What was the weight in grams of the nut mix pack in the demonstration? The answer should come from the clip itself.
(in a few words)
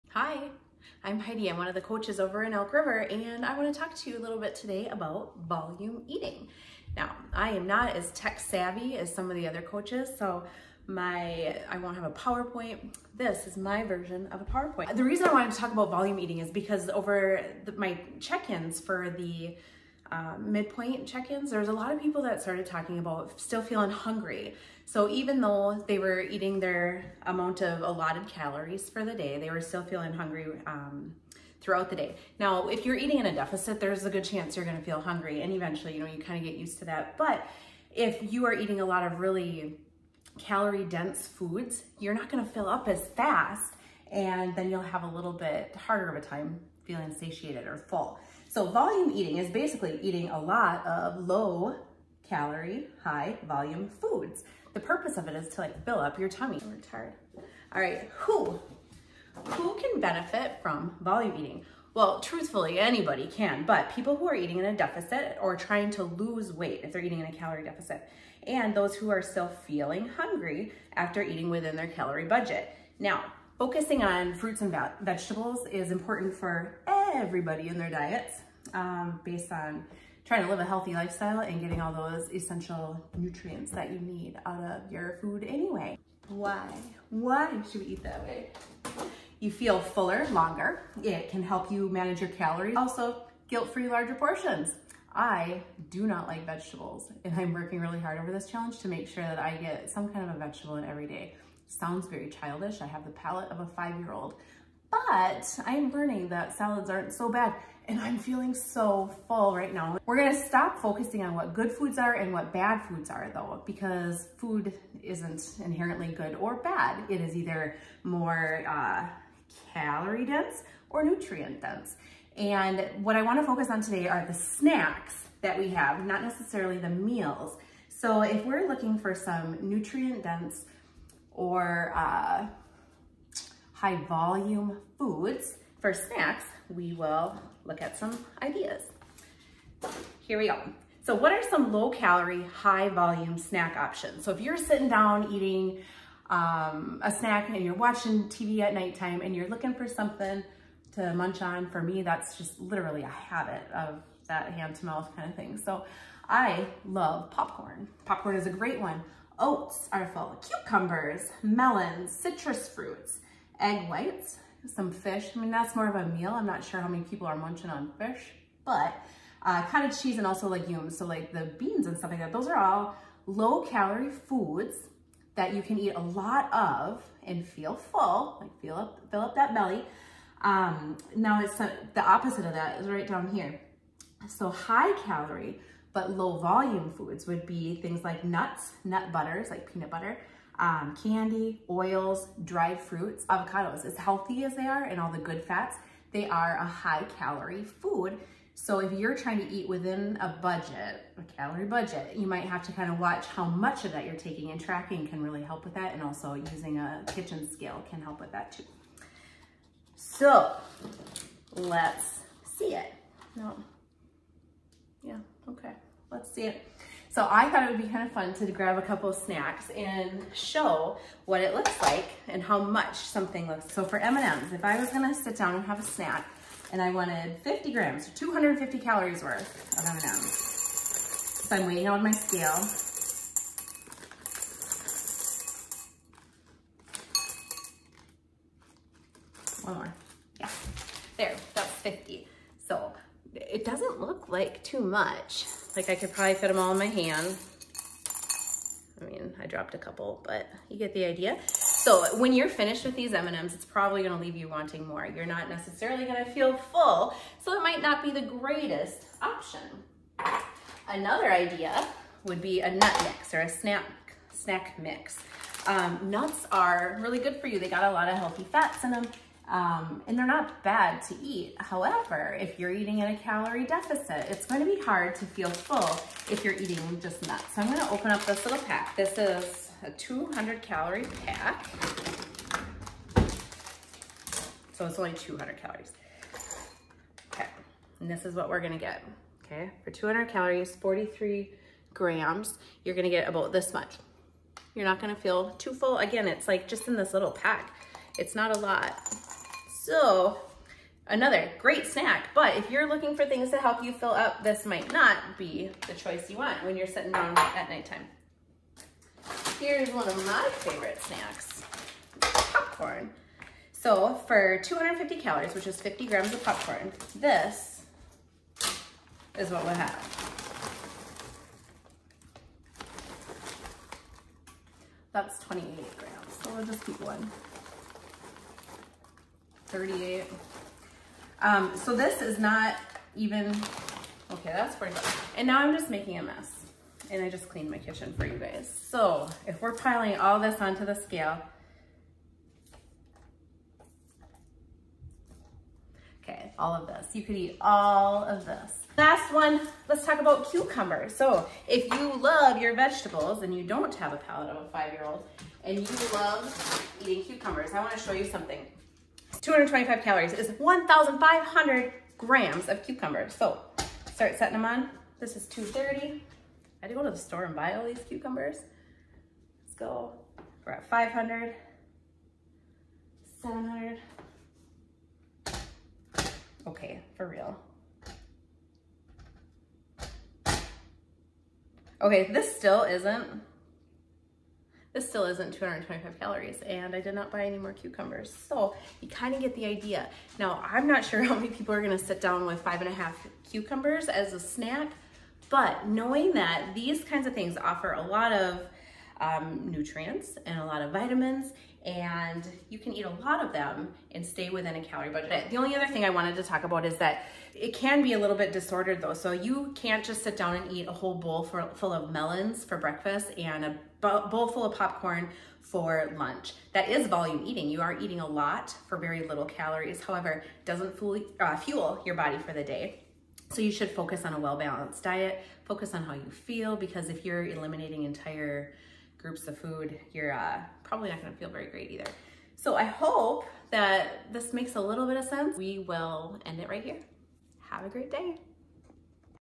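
43.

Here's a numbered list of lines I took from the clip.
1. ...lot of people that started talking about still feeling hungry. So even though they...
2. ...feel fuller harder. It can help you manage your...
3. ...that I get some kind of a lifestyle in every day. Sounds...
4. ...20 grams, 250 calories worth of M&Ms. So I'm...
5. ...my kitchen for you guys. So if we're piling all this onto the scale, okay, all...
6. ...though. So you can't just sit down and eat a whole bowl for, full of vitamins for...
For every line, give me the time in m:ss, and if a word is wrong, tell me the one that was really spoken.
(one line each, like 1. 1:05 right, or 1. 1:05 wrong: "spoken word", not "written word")
1. 0:21 right
2. 1:29 wrong: "longer", not "harder"
3. 1:39 wrong: "vegetable", not "lifestyle"
4. 3:47 wrong: "50", not "20"
5. 5:37 right
6. 6:49 wrong: "melons", not "vitamins".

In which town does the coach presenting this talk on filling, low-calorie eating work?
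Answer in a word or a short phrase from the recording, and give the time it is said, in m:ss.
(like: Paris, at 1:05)
Elk River, at 0:02.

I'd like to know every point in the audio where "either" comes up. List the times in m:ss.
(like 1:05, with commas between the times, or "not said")
1:57, 7:11.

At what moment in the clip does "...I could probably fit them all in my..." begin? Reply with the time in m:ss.
4:05.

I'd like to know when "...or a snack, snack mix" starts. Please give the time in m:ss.
4:23.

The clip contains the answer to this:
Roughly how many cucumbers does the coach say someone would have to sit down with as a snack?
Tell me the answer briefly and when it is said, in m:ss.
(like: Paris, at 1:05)
5 and a half, at 6:32.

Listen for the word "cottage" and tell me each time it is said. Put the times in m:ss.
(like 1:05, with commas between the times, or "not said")
2:49.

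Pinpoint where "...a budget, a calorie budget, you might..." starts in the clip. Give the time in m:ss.
3:20.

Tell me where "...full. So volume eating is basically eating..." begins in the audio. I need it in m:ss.
0:47.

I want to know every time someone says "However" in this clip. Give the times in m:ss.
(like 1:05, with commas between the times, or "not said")
4:31, 7:00.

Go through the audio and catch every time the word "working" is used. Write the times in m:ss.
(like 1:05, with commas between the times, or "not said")
1:37.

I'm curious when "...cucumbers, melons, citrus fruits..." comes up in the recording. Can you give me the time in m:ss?
2:40.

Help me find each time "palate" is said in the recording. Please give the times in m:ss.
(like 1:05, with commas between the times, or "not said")
1:43, 5:54.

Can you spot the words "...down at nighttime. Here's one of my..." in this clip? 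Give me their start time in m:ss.
5:07.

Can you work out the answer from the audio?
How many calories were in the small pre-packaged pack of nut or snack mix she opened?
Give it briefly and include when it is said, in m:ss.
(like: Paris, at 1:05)
200, at 4:39.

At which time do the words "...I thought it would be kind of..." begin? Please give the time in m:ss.
3:37.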